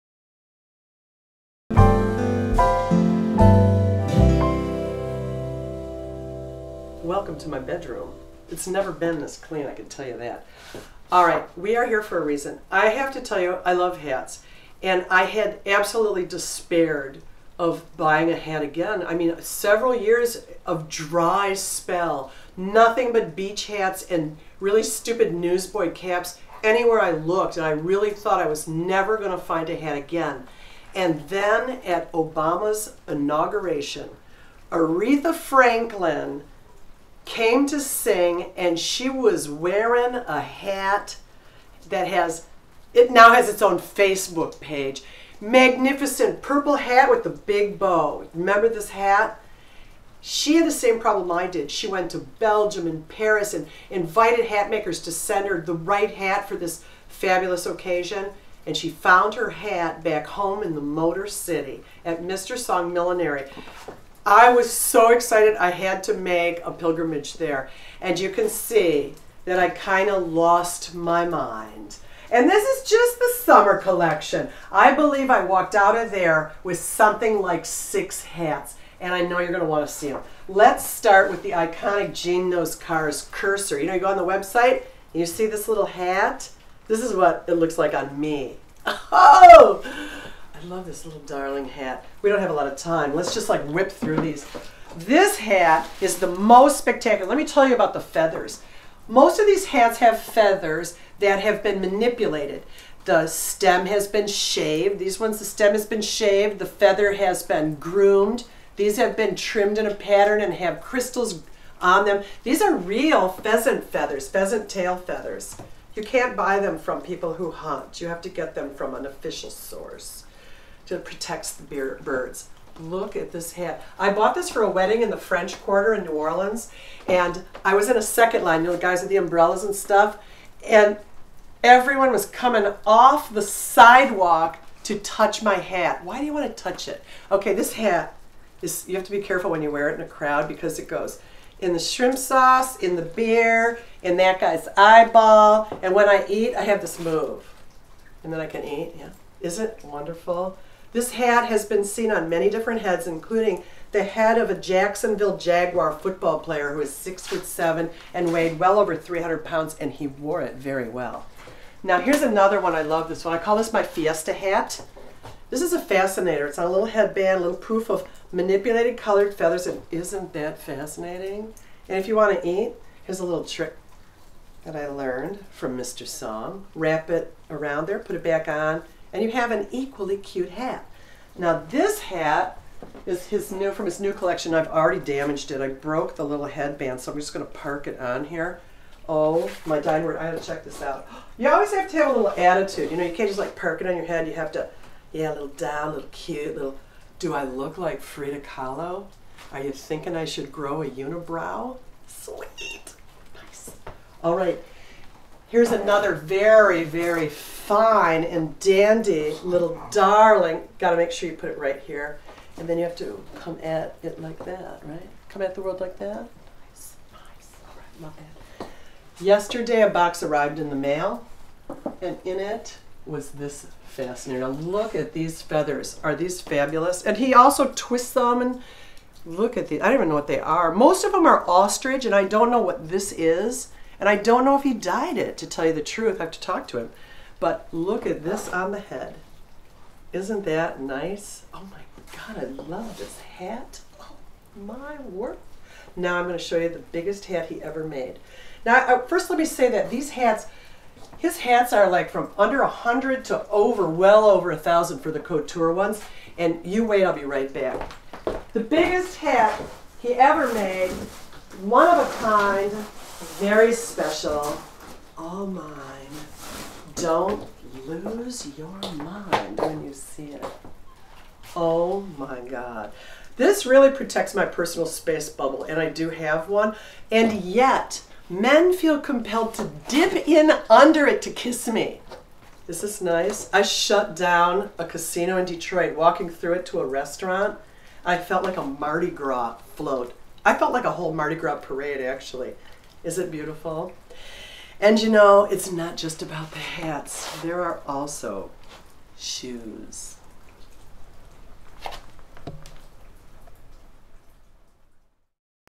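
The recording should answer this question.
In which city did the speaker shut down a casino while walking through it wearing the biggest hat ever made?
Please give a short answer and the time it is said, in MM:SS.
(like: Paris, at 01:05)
Detroit, at 04:45.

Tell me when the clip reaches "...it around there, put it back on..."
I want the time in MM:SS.
02:57.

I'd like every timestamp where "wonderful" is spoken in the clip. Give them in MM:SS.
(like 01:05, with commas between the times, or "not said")
02:29.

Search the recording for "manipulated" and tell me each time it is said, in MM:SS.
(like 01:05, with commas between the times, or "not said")
01:41, 02:48.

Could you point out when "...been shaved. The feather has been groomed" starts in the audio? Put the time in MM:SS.
01:45.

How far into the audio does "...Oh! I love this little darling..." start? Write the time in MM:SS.
01:29.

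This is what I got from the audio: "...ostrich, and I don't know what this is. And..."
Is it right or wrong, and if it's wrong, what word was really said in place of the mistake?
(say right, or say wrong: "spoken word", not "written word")
right.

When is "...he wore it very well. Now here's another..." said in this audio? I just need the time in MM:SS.
02:39.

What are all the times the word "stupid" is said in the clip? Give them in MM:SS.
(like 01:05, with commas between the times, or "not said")
00:24.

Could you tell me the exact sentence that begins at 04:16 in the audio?
And you wait, I'll be right back.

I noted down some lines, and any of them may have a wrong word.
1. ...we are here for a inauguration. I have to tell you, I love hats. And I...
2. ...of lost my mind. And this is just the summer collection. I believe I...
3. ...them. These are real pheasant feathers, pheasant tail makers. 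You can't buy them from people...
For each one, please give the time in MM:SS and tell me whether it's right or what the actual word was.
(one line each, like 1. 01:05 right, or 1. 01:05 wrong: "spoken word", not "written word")
1. 00:11 wrong: "reason", not "inauguration"
2. 01:10 right
3. 01:52 wrong: "feathers", not "makers".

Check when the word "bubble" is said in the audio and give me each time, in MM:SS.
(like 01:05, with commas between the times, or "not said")
04:35.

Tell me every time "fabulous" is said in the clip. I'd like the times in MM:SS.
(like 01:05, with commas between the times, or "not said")
00:57, 03:46.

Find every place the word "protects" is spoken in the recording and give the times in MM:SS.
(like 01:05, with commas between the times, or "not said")
02:01, 04:33.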